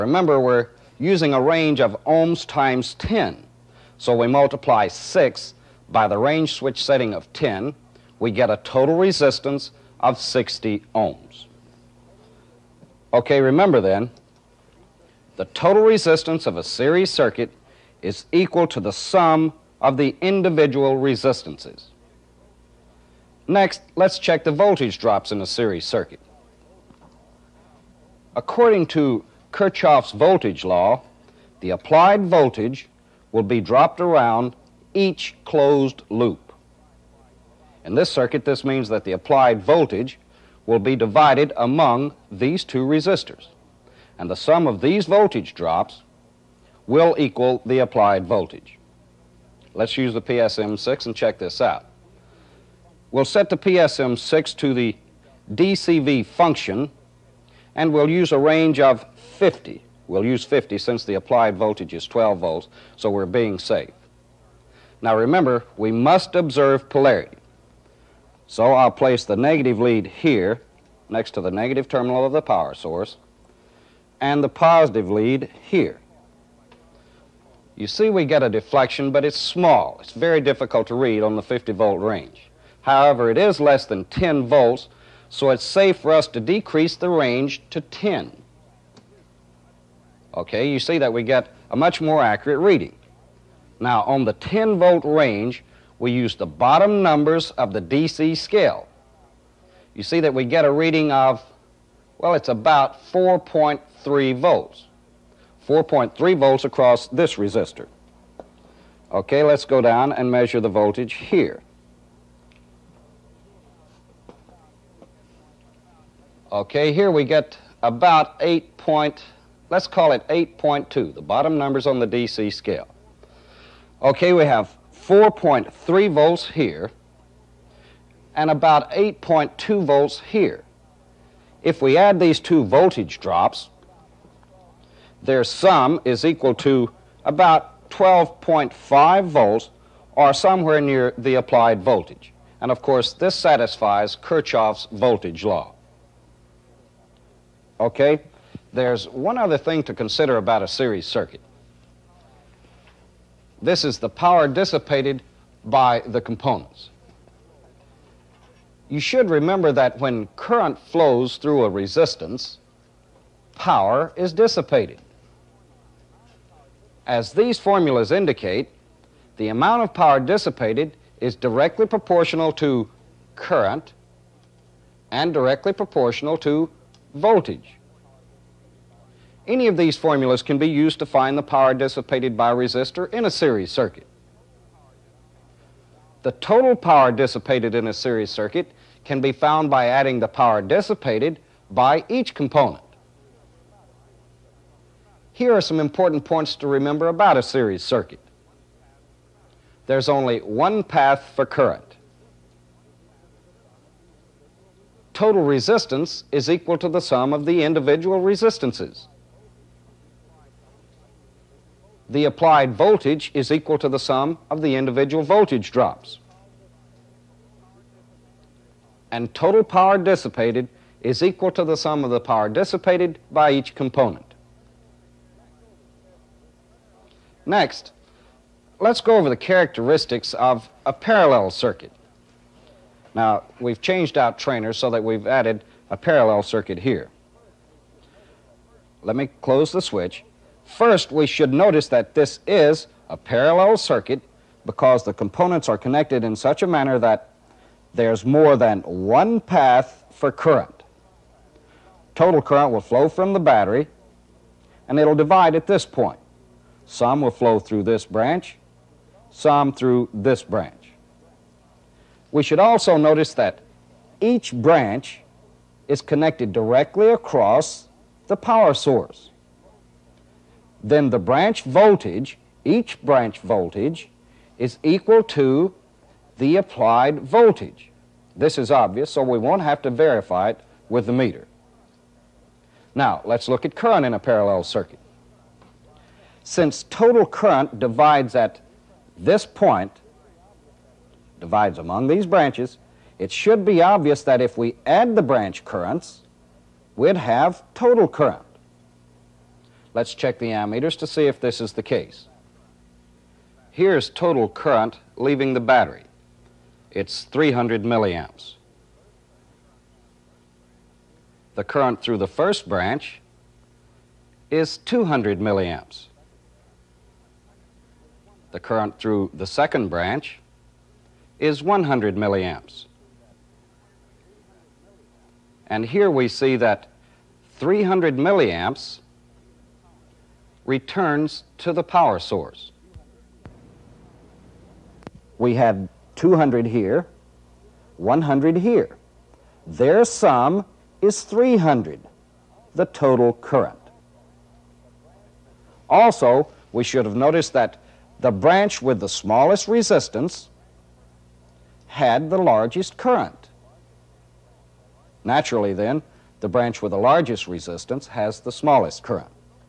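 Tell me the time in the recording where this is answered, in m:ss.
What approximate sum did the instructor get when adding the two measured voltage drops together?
2:17.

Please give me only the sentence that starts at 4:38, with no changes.
This is obvious, so we won't have to verify it with the meter.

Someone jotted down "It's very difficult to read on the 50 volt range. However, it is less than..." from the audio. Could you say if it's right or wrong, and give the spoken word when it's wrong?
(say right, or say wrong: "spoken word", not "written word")
right.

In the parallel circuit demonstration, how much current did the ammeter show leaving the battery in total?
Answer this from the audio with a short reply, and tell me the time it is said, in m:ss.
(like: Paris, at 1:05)
300 milliamps, at 5:06.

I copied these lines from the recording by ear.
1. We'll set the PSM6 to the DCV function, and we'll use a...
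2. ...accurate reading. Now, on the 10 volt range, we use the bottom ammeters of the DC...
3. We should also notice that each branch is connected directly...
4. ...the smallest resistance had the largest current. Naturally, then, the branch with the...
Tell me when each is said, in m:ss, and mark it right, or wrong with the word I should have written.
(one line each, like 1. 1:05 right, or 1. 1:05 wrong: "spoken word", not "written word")
1. 0:53 right
2. 1:32 wrong: "numbers", not "ammeters"
3. 4:22 right
4. 5:48 right.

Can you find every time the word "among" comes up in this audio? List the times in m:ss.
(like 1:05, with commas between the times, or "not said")
0:41, 4:51.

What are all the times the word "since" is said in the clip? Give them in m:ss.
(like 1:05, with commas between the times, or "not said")
1:00, 4:46.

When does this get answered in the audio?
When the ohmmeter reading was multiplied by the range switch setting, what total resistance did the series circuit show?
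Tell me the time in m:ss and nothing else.
0:10.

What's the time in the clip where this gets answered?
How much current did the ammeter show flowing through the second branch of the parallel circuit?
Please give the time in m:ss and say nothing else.
5:21.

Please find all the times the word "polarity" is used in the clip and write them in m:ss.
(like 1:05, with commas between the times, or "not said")
1:06.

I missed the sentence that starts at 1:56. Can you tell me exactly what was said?
Okay, here we get about 8.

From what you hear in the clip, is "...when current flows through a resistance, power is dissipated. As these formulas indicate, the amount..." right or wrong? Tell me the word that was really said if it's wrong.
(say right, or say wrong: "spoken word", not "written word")
right.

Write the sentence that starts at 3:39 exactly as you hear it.
And total power dissipated is equal to the sum of the power dissipated by each component.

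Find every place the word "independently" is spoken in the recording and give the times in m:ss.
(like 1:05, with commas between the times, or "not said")
not said.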